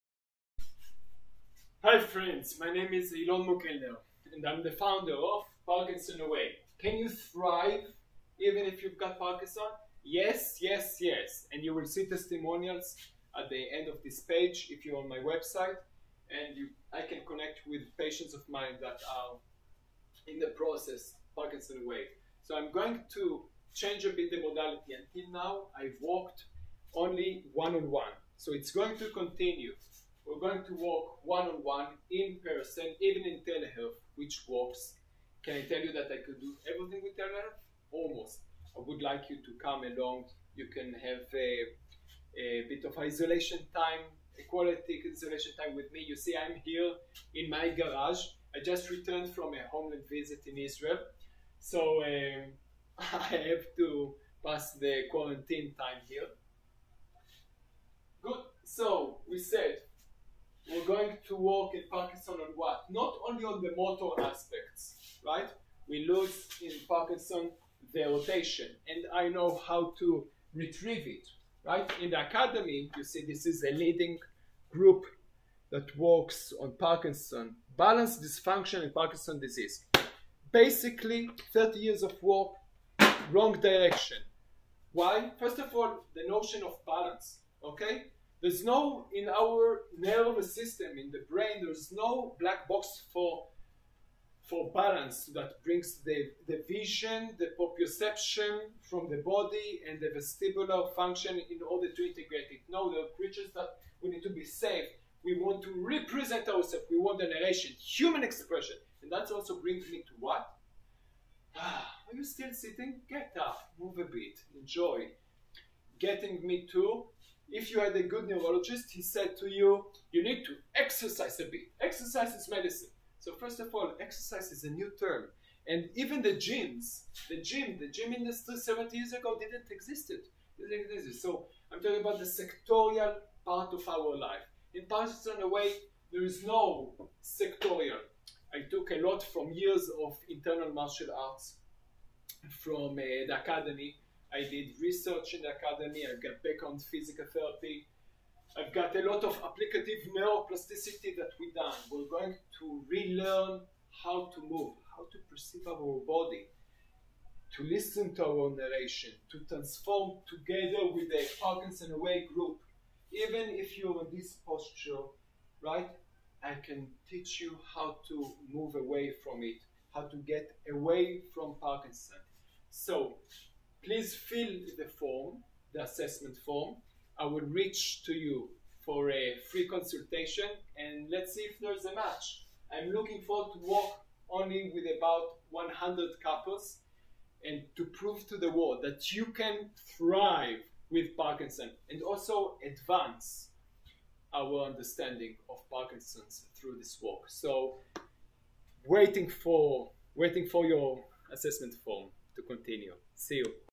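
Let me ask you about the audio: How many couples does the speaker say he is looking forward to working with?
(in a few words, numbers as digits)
100.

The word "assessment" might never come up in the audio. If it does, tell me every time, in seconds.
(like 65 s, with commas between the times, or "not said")
175 s, 201 s.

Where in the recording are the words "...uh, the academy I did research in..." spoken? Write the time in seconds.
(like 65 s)
142 s.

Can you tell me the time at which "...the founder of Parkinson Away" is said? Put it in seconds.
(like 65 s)
4 s.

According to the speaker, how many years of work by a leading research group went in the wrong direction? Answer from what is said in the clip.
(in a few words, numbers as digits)
30.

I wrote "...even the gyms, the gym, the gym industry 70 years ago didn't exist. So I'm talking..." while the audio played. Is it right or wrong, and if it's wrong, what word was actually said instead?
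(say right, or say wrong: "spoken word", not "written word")
right.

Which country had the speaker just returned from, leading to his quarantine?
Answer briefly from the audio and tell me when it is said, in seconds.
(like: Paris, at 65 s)
Israel, at 50 s.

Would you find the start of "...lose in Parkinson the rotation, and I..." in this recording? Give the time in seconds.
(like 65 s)
66 s.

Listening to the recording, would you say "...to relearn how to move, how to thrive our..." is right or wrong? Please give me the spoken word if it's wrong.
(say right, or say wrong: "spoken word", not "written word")
wrong: "perceive", not "thrive".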